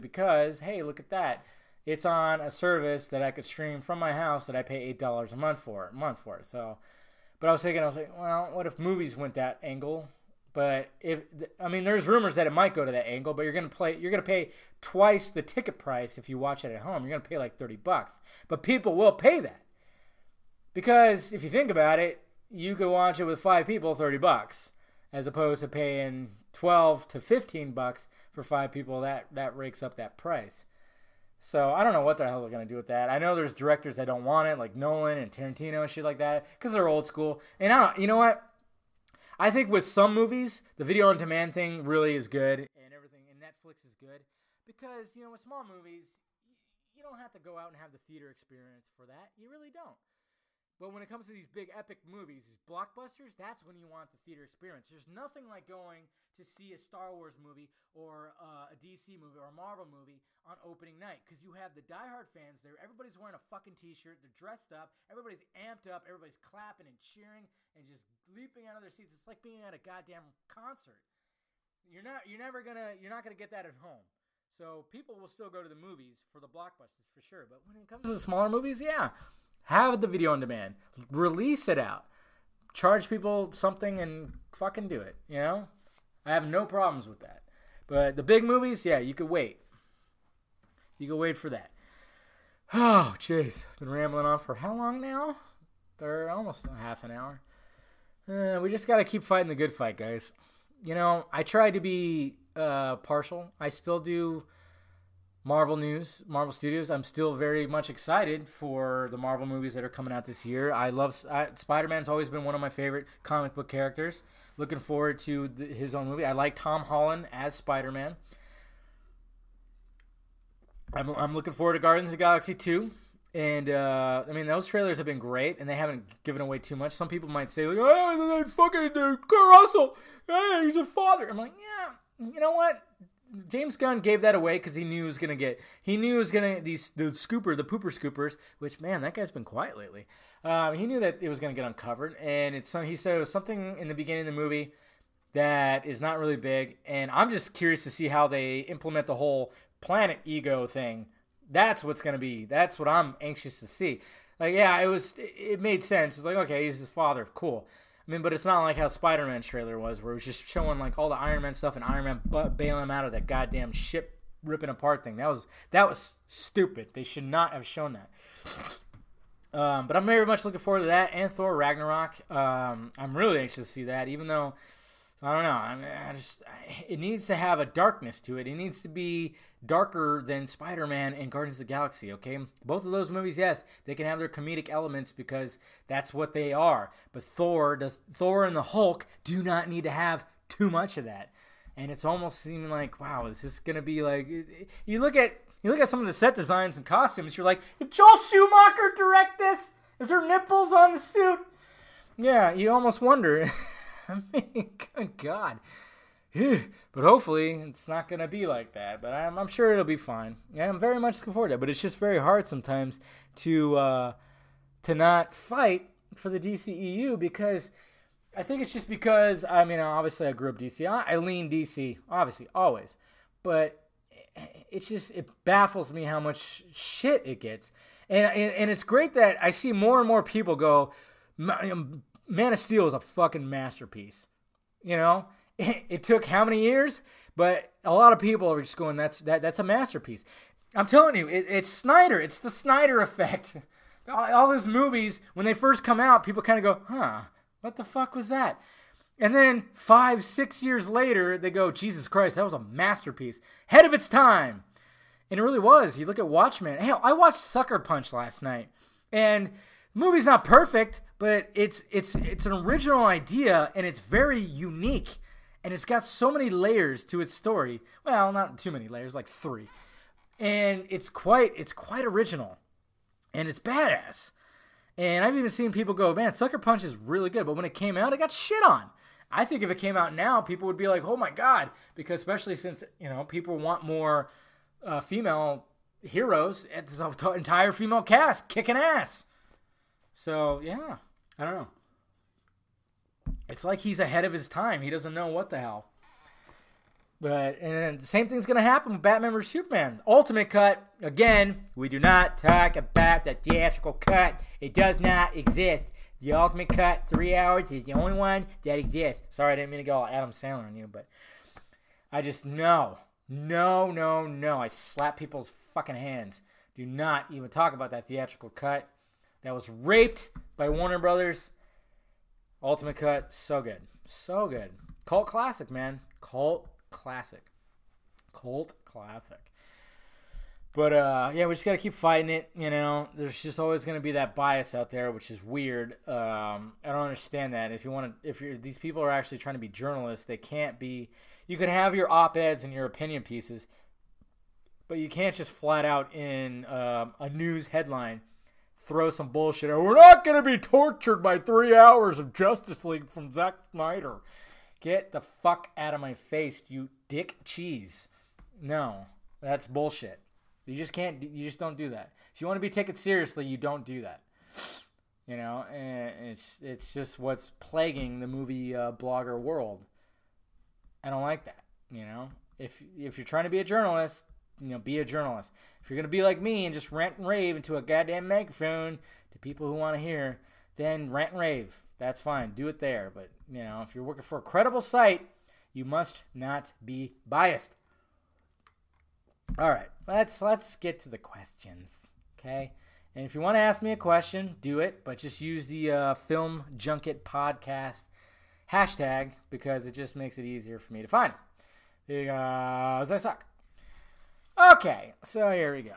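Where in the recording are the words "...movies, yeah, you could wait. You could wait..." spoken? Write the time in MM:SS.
01:28.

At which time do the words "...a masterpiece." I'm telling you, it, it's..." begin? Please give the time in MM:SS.
03:59.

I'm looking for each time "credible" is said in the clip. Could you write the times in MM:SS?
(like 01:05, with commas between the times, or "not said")
06:24.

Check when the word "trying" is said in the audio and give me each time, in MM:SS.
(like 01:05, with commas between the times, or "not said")
05:39, 06:13.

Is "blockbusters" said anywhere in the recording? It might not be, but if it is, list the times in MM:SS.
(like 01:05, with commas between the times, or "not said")
00:52, 01:16.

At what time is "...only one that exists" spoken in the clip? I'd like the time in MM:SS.
05:07.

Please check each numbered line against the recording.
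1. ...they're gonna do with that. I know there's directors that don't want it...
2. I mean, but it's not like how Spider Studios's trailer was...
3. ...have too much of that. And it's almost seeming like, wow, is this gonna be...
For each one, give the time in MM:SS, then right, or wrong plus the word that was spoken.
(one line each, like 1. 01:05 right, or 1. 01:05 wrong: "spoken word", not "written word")
1. 00:32 right
2. 02:38 wrong: "Man", not "Studios"
3. 03:09 right.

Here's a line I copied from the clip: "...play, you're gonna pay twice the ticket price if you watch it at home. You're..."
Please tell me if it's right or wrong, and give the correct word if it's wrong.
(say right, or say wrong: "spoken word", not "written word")
right.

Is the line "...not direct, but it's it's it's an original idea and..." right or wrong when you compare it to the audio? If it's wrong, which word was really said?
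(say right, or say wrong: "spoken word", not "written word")
wrong: "perfect", not "direct".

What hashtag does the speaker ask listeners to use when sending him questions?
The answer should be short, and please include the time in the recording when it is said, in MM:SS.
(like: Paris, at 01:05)
film junket podcast, at 06:36.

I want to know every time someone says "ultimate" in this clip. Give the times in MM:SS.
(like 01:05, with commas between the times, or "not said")
05:00, 05:06, 05:22.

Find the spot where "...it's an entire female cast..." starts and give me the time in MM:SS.
04:46.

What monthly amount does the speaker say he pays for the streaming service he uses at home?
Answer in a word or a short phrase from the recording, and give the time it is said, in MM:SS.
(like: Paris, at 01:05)
$8, at 00:04.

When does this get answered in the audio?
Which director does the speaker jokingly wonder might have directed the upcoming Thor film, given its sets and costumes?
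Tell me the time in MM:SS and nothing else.
03:17.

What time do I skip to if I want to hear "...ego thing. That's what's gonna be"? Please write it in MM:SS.
02:30.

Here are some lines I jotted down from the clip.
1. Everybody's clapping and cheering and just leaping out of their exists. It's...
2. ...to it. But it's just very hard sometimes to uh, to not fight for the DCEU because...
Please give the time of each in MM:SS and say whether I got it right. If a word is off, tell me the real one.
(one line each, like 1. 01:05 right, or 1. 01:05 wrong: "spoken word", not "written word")
1. 01:06 wrong: "seats", not "exists"
2. 03:31 right.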